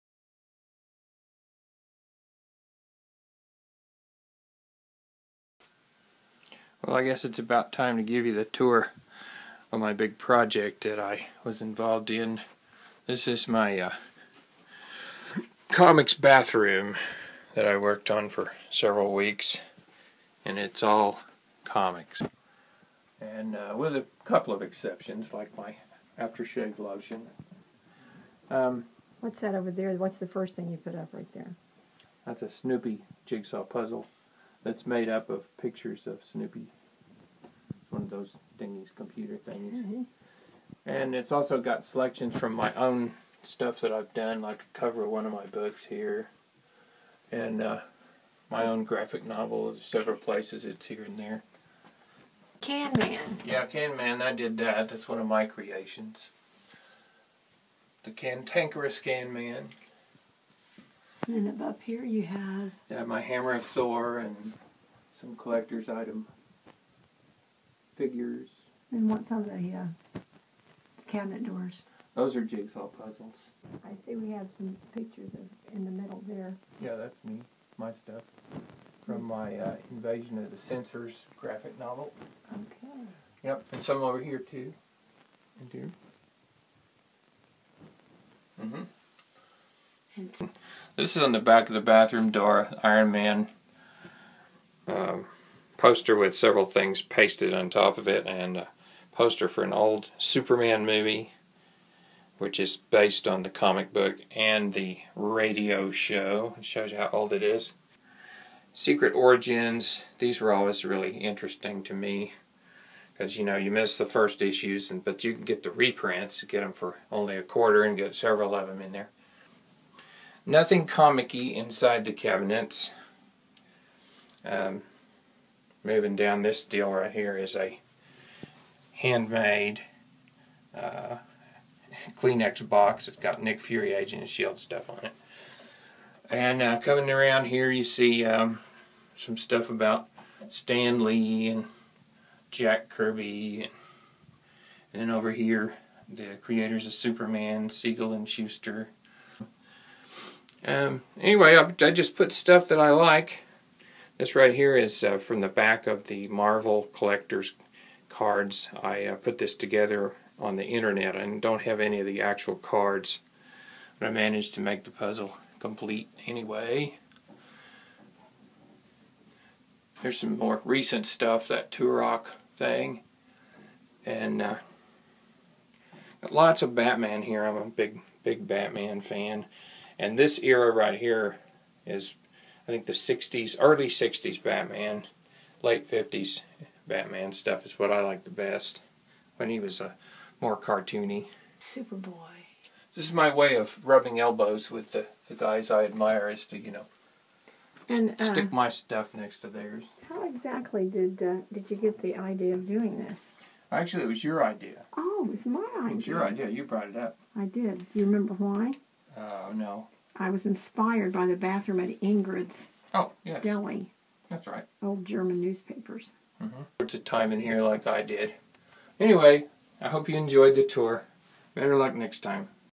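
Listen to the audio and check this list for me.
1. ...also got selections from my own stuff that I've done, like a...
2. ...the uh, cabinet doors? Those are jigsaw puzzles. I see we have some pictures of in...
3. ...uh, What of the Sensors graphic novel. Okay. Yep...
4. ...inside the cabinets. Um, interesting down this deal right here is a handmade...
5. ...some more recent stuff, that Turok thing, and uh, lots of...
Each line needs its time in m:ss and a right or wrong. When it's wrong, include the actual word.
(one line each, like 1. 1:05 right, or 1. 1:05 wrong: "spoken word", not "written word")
1. 0:41 right
2. 1:09 right
3. 1:19 wrong: "Invasion", not "What"
4. 2:01 wrong: "moving", not "interesting"
5. 2:50 right.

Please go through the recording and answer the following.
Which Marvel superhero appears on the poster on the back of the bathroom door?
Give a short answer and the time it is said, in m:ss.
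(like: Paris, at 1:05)
Iron Man, at 1:32.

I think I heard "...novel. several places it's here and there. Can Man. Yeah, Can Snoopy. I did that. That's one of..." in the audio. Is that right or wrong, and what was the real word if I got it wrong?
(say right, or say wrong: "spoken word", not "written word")
wrong: "Man", not "Snoopy".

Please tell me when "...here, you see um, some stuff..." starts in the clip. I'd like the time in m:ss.
2:17.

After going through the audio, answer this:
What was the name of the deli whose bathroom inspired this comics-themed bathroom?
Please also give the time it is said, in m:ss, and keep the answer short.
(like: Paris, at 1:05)
Ingrid's, at 3:32.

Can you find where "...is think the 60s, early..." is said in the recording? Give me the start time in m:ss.
3:01.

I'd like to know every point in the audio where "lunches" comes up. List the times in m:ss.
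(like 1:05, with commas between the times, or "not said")
not said.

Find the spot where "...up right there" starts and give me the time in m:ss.
0:30.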